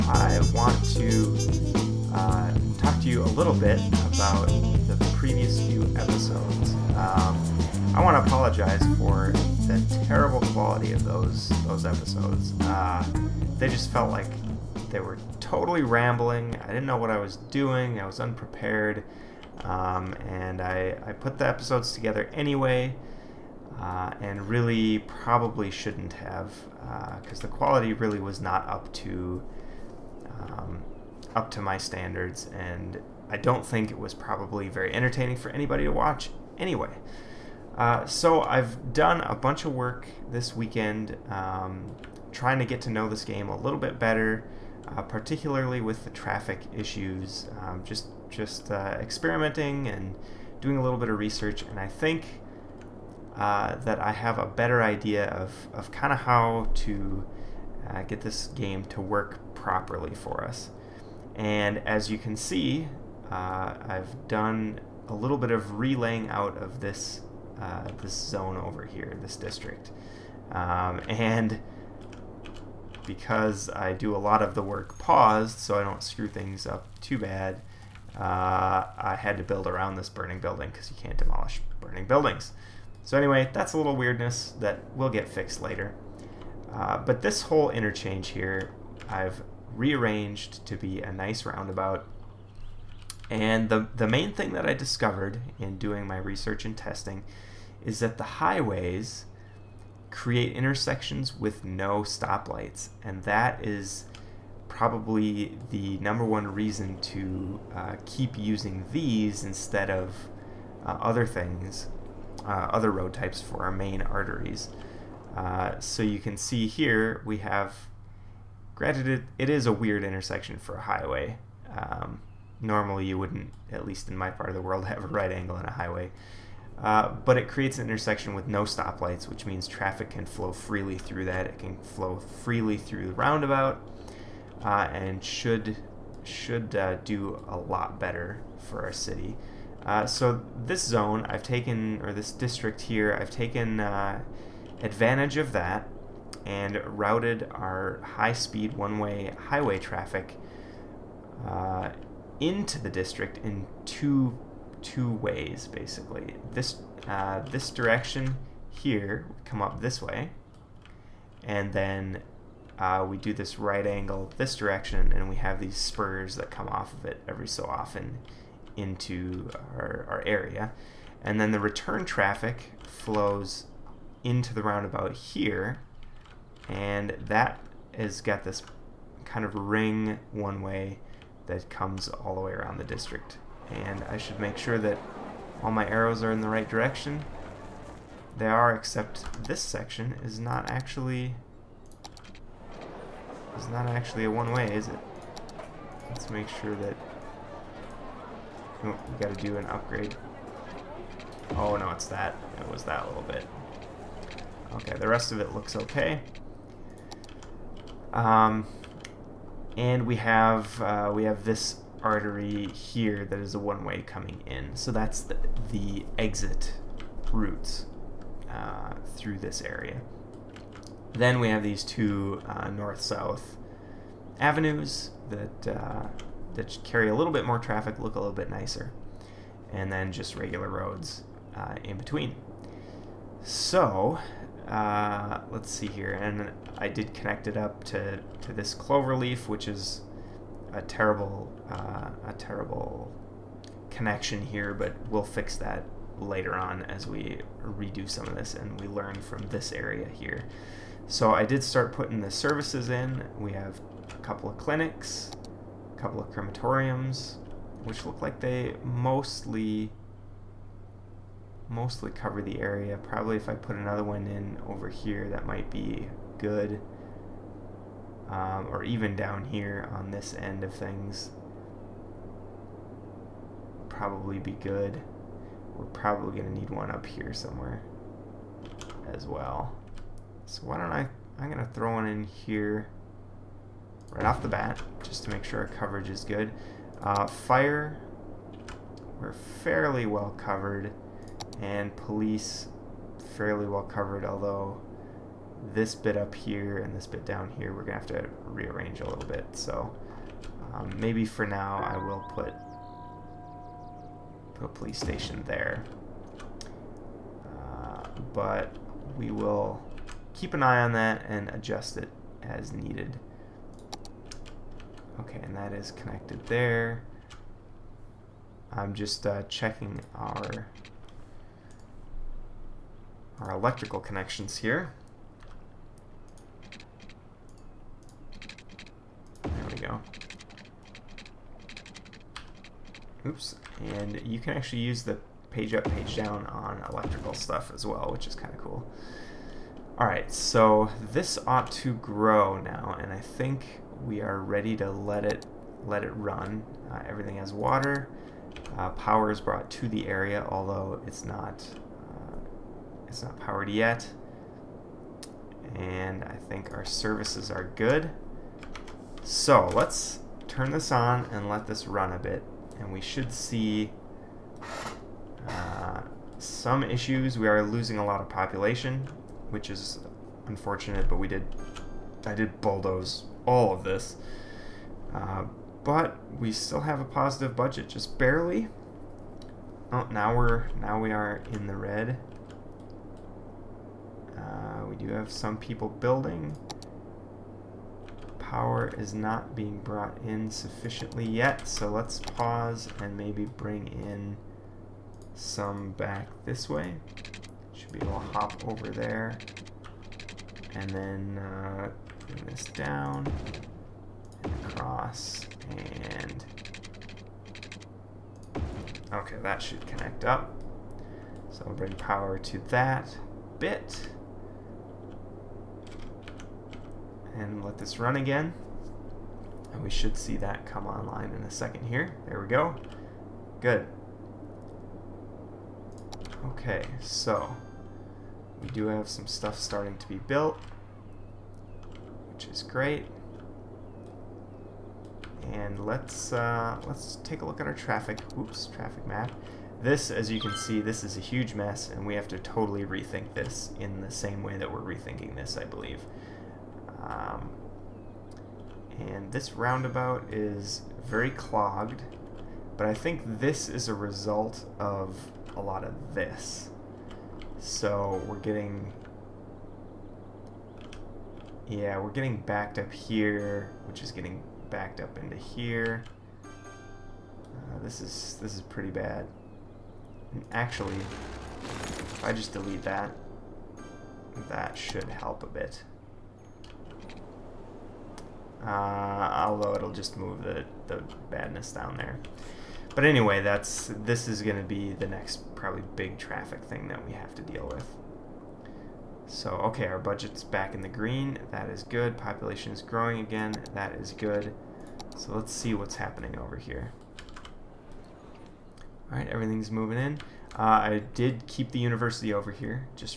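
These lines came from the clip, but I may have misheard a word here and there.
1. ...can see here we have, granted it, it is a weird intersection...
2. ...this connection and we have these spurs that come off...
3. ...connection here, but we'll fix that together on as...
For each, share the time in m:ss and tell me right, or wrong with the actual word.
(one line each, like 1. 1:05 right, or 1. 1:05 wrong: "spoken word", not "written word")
1. 1:56 right
2. 2:44 wrong: "direction", not "connection"
3. 4:03 wrong: "later", not "together".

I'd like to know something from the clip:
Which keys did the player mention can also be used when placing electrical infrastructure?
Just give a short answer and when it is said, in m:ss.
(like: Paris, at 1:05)
page up, page down, at 5:35.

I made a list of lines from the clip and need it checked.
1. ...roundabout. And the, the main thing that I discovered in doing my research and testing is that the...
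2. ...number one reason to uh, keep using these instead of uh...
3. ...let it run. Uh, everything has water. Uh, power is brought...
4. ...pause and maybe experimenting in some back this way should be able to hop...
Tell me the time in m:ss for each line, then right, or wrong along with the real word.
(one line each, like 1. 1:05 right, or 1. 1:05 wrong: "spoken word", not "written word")
1. 1:31 right
2. 1:45 right
3. 5:45 right
4. 6:32 wrong: "bring", not "experimenting".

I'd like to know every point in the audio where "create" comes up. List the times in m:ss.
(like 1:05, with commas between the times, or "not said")
1:40, 2:07.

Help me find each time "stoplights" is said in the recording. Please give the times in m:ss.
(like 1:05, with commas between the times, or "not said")
1:42, 2:08.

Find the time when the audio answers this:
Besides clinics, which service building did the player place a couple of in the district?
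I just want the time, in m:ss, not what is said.
4:16.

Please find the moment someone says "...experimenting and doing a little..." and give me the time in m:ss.
0:49.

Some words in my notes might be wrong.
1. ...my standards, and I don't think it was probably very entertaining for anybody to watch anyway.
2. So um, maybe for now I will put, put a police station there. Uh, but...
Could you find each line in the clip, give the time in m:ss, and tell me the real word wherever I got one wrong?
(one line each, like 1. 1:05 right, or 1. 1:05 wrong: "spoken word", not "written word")
1. 0:31 right
2. 4:59 right.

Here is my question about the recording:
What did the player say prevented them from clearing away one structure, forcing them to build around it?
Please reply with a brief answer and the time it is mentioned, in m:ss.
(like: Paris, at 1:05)
burning building, at 1:20.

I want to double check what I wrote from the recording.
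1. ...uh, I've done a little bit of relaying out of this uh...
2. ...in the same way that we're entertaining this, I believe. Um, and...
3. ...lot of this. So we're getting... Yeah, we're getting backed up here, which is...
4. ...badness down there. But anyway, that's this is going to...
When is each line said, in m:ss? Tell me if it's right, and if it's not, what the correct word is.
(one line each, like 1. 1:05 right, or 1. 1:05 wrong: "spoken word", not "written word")
1. 1:03 right
2. 7:23 wrong: "rethinking", not "entertaining"
3. 7:35 right
4. 8:01 right.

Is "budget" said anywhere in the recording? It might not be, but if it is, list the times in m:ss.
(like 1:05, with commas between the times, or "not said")
6:17, 8:09.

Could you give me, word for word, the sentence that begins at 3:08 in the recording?
They are, except this section is not actually it's not actually a one-way, is it?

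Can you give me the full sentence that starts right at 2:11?
It can flow freely through the roundabout uh, and should should uh, do a lot better for our city.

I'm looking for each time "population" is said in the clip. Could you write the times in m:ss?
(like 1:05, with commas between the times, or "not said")
6:08, 8:12.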